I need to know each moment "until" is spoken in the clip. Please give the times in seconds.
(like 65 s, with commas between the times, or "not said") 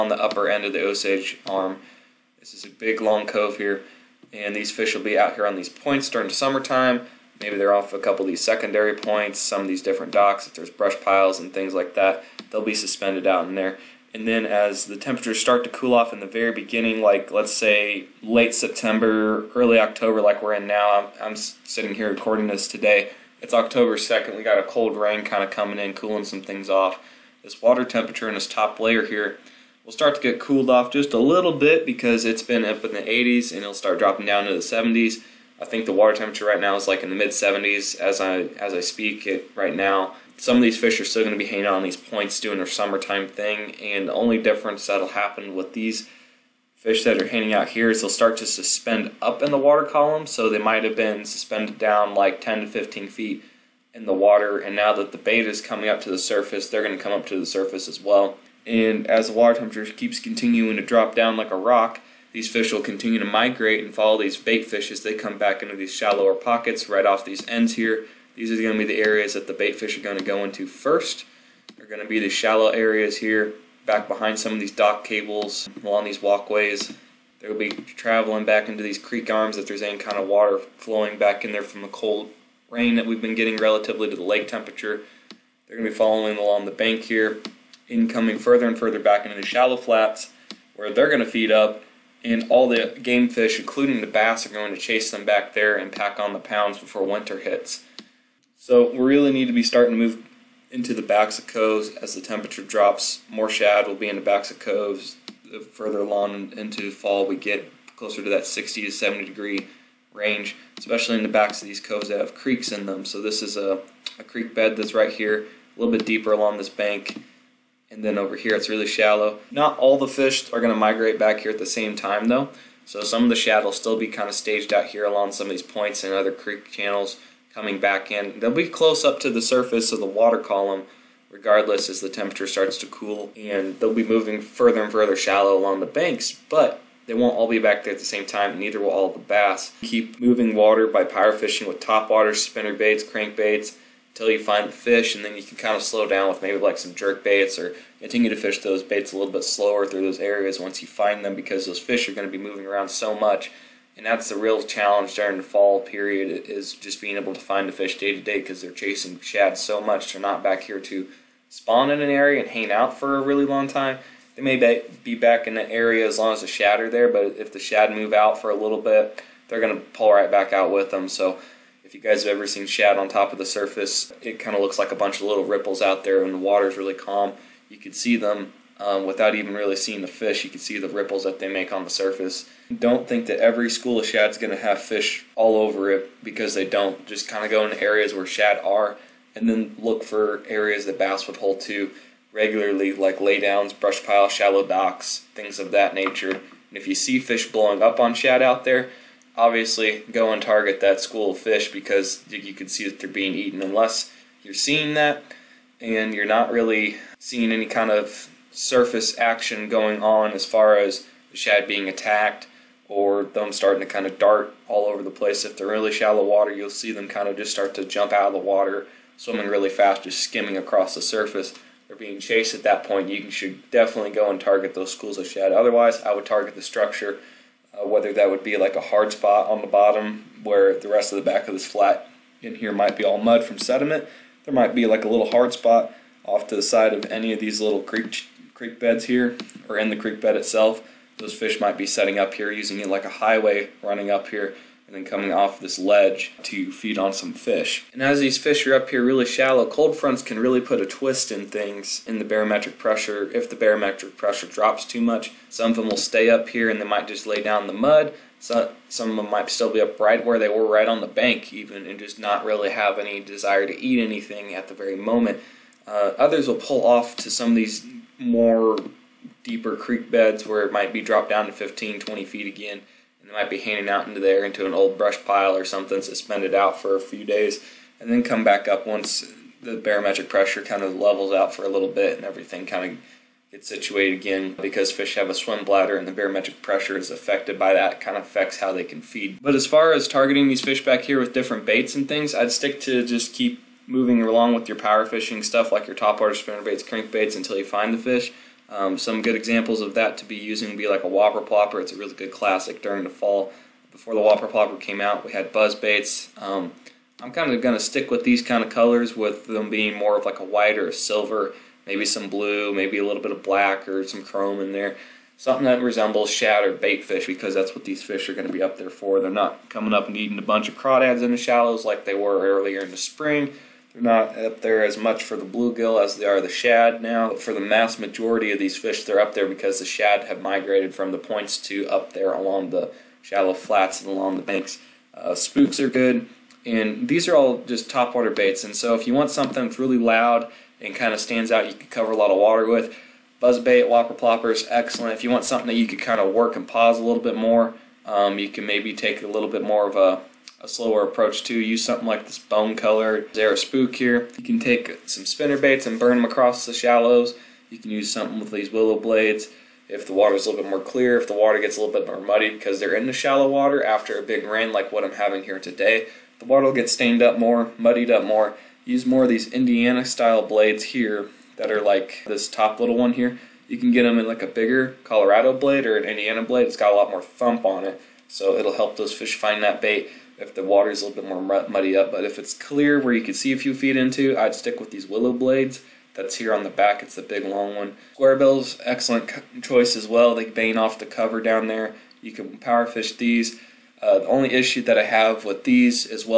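144 s, 297 s.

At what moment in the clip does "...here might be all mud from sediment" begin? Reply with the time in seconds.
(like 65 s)
232 s.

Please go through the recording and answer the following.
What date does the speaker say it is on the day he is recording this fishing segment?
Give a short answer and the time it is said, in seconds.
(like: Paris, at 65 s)
October 2, at 23 s.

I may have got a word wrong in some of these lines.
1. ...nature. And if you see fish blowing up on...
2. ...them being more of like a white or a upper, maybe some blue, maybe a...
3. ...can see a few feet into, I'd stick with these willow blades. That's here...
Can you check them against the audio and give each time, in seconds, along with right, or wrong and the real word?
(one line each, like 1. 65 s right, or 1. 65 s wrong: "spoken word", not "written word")
1. 195 s right
2. 309 s wrong: "silver", not "upper"
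3. 383 s right.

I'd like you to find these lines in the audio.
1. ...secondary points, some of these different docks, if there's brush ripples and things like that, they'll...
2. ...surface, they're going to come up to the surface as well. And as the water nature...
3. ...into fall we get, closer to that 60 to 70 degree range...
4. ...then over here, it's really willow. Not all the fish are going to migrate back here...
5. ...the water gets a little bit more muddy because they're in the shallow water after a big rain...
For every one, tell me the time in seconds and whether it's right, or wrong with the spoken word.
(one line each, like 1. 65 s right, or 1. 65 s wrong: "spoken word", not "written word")
1. 8 s wrong: "piles", not "ripples"
2. 56 s wrong: "temperature", not "nature"
3. 106 s right
4. 118 s wrong: "shallow", not "willow"
5. 361 s right.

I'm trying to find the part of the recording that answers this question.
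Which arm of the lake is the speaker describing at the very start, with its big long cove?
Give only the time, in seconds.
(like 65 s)
0 s.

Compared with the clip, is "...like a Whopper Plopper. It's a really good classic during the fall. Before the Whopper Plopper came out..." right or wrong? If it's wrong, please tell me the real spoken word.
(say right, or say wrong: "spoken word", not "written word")
right.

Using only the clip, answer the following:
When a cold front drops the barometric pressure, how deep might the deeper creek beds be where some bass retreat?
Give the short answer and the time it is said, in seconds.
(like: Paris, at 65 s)
15 to 20 feet, at 271 s.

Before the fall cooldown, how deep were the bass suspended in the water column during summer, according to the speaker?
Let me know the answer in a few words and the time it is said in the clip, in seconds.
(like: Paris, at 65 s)
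10 to 15 feet, at 52 s.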